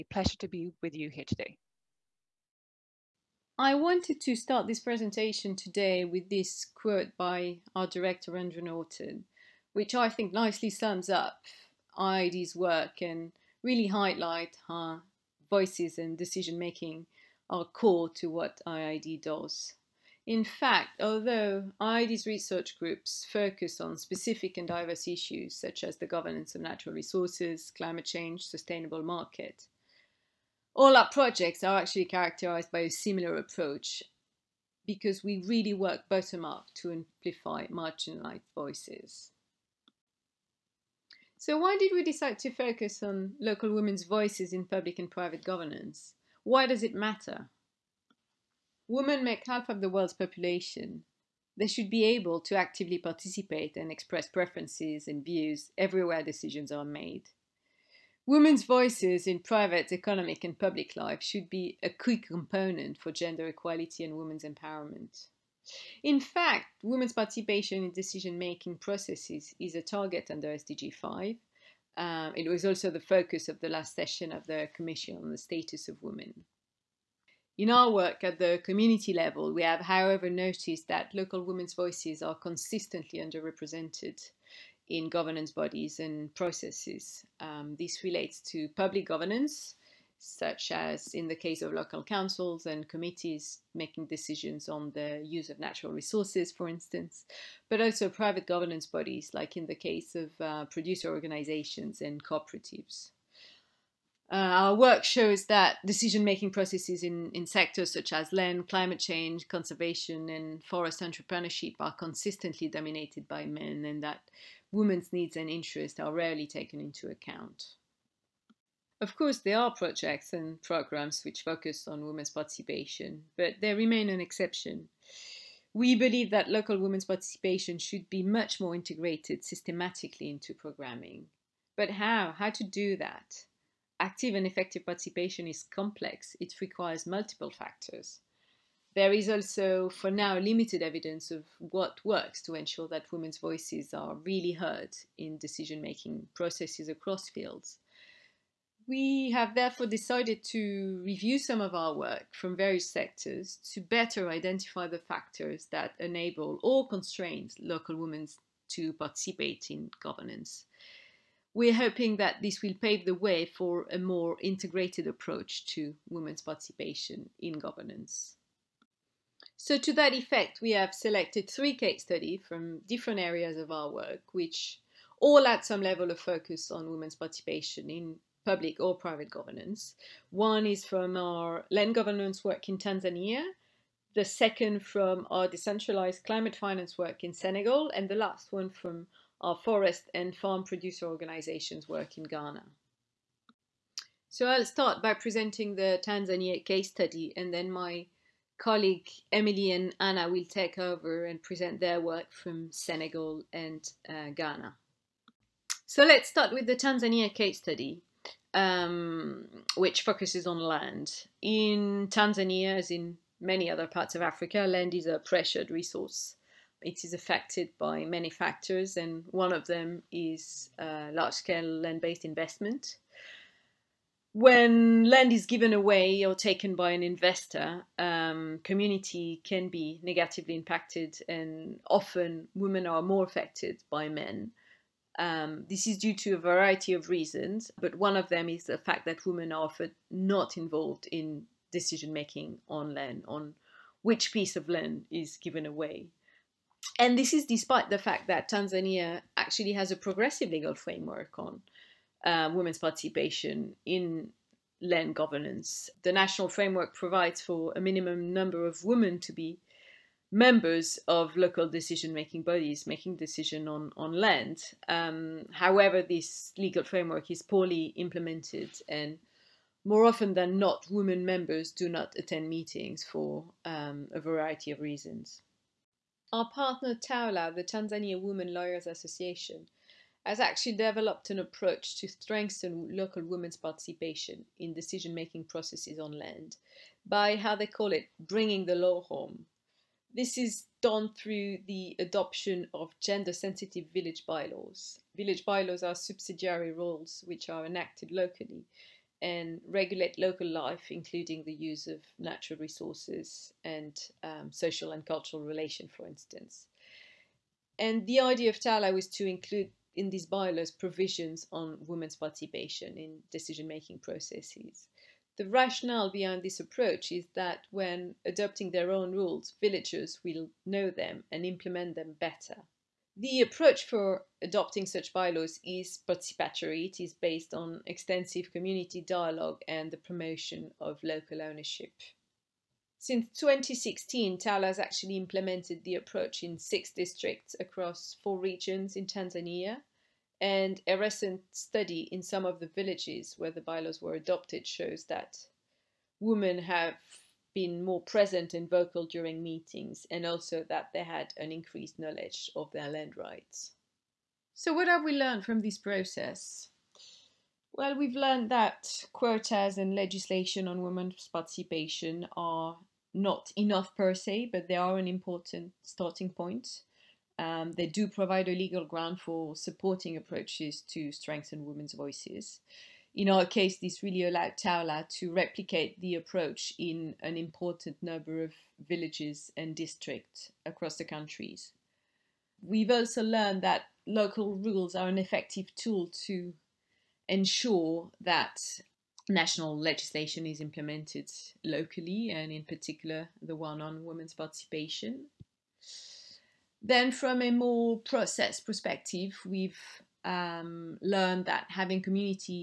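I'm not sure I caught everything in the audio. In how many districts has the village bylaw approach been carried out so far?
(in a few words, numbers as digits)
6.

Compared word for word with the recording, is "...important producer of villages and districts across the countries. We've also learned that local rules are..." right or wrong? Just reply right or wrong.
wrong.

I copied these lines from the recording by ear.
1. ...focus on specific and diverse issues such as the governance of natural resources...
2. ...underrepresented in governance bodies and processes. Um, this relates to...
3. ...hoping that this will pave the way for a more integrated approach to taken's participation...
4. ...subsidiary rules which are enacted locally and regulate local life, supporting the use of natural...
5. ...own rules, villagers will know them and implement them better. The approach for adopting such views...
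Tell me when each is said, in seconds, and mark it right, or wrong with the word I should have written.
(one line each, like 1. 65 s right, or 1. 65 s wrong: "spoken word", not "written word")
1. 23 s right
2. 83 s right
3. 161 s wrong: "women", not "taken"
4. 295 s wrong: "including", not "supporting"
5. 318 s wrong: "bylaws", not "views".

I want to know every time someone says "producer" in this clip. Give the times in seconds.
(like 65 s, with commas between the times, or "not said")
100 s, 190 s.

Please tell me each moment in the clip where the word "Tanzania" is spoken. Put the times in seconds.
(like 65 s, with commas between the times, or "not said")
182 s, 196 s, 206 s, 212 s, 248 s, 277 s, 339 s.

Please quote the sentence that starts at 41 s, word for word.
So why did we decide to focus on local women's voices in public and private governance?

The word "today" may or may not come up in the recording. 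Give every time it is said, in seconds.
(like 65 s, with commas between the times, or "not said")
1 s, 5 s.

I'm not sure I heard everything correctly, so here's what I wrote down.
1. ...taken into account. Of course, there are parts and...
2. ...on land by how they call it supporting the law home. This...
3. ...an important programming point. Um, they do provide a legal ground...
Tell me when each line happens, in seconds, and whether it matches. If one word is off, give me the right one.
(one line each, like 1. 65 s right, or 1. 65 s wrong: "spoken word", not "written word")
1. 116 s wrong: "projects", not "parts"
2. 285 s wrong: "bringing", not "supporting"
3. 364 s wrong: "starting", not "programming".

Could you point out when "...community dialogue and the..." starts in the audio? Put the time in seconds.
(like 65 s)
328 s.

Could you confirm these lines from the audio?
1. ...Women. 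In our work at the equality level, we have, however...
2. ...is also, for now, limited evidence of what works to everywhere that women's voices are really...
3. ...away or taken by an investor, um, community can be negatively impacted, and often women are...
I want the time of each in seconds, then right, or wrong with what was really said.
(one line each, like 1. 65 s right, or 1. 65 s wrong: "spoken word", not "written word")
1. 76 s wrong: "community", not "equality"
2. 139 s wrong: "ensure", not "everywhere"
3. 225 s right.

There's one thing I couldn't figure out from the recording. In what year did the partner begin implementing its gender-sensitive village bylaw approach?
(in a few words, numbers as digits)
2016.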